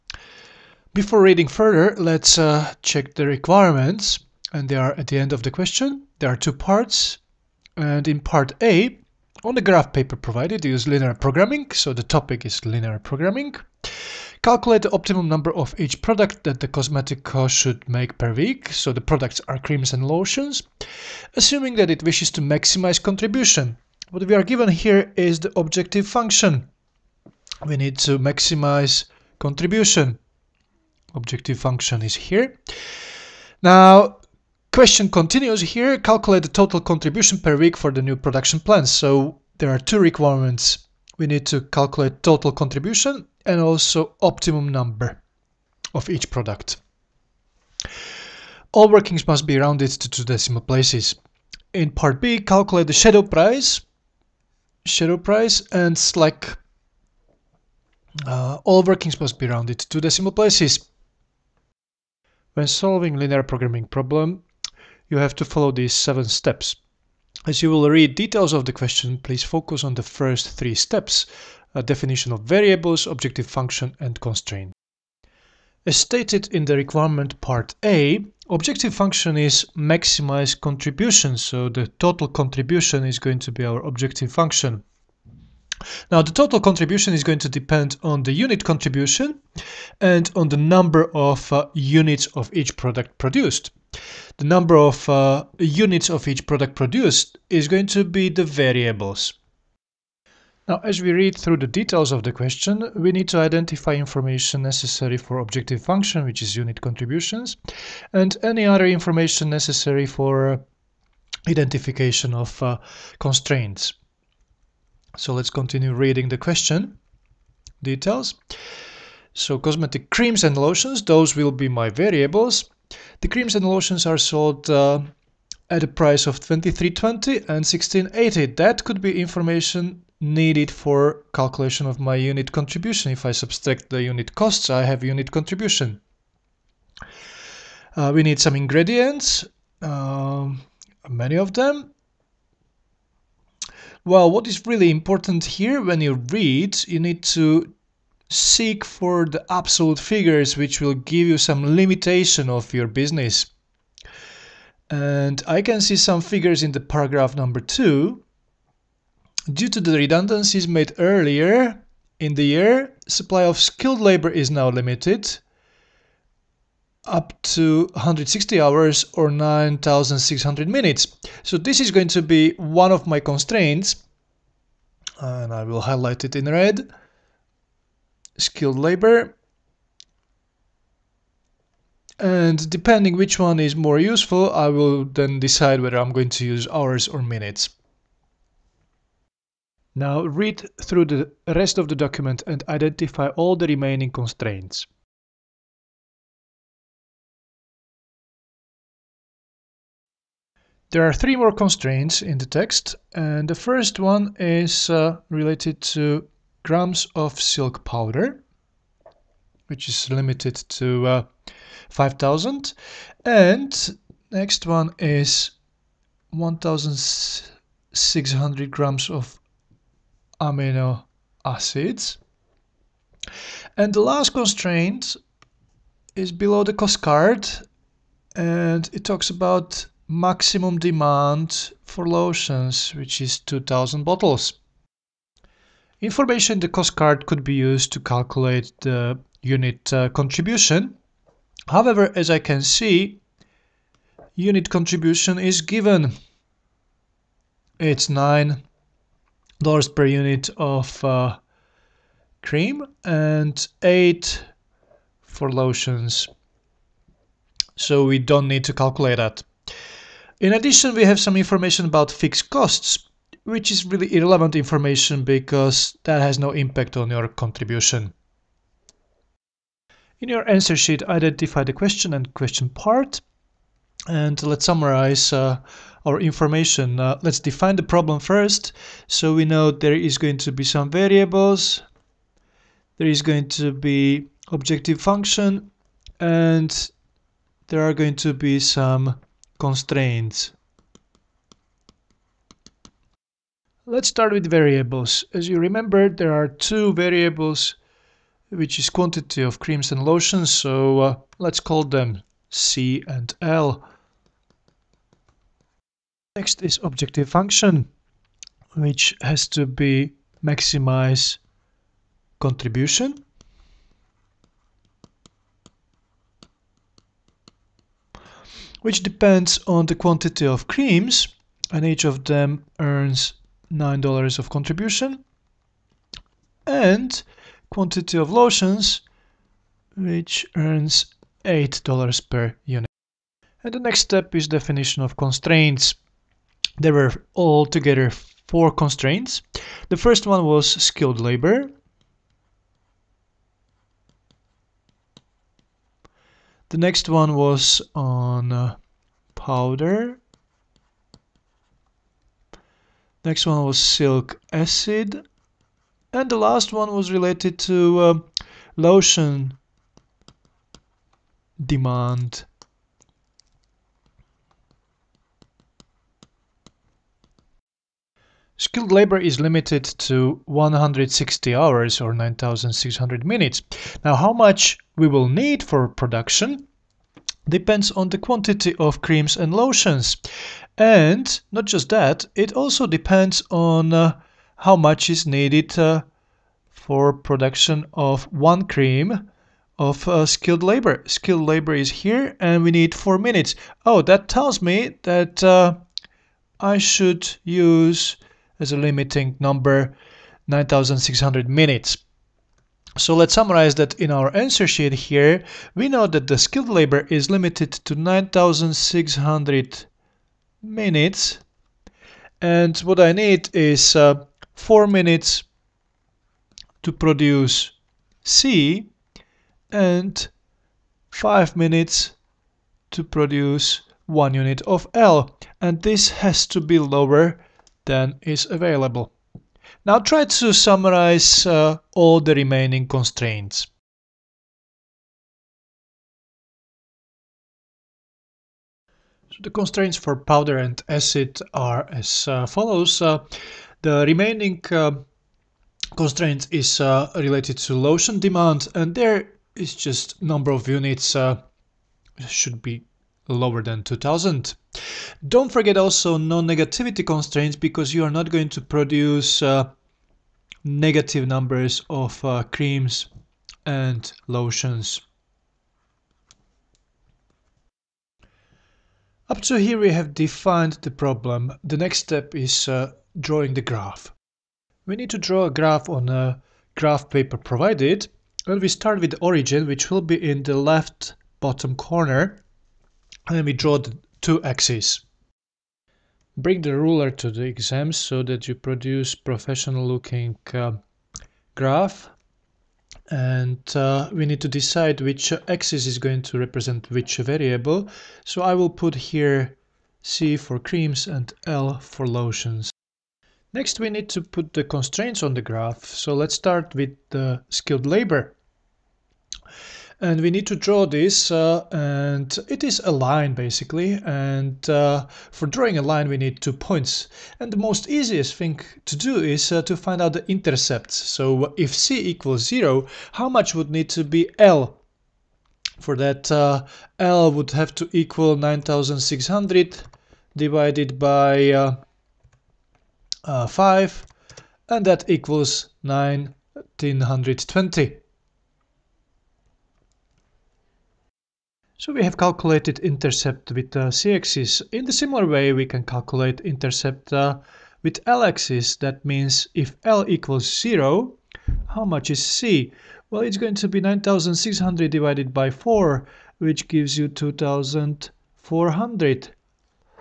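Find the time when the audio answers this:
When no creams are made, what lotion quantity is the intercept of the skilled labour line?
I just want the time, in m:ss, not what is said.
8:55.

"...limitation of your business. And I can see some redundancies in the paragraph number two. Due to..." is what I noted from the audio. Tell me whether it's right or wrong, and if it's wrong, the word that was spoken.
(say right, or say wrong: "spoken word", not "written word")
wrong: "figures", not "redundancies".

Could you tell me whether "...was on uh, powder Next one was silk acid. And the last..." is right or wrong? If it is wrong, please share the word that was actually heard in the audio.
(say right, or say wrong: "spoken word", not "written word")
right.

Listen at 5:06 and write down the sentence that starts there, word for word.
Next is objective function, which has to be maximize contribution.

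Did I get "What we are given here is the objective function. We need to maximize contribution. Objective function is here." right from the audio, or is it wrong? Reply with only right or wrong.
right.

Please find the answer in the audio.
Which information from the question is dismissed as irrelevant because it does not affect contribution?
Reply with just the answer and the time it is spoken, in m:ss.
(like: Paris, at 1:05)
fixed costs, at 4:22.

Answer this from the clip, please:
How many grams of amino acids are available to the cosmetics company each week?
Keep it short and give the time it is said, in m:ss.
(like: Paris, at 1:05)
1600, at 3:36.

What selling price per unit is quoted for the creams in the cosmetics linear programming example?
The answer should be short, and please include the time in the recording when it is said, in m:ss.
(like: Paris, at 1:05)
23.20, at 2:06.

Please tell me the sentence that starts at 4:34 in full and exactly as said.
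And let's summarize uh, our information.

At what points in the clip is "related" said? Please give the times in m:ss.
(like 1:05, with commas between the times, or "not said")
3:25, 5:57, 7:27.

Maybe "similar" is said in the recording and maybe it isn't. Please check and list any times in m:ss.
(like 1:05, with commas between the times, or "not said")
9:04.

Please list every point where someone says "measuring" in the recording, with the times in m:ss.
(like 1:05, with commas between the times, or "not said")
not said.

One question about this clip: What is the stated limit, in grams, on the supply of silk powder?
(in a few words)
5000.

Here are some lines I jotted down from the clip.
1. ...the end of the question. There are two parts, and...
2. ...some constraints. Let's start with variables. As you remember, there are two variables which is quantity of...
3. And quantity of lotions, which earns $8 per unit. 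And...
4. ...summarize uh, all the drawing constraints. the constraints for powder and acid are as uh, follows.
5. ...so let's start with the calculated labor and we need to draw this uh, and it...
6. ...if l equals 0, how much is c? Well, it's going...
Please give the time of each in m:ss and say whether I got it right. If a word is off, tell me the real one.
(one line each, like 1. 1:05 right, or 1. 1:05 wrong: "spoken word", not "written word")
1. 0:05 right
2. 4:48 right
3. 5:26 right
4. 7:10 wrong: "remaining", not "drawing"
5. 8:25 wrong: "skilled", not "calculated"
6. 9:09 right.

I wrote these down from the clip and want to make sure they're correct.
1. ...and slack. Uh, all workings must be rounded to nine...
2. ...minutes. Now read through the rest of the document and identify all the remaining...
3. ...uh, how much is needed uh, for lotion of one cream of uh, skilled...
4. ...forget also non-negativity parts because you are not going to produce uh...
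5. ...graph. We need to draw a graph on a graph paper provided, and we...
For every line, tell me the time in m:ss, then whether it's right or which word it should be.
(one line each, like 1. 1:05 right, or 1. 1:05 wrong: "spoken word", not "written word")
1. 0:55 wrong: "two", not "nine"
2. 3:07 right
3. 6:23 wrong: "production", not "lotion"
4. 7:35 wrong: "constraints", not "parts"
5. 7:53 right.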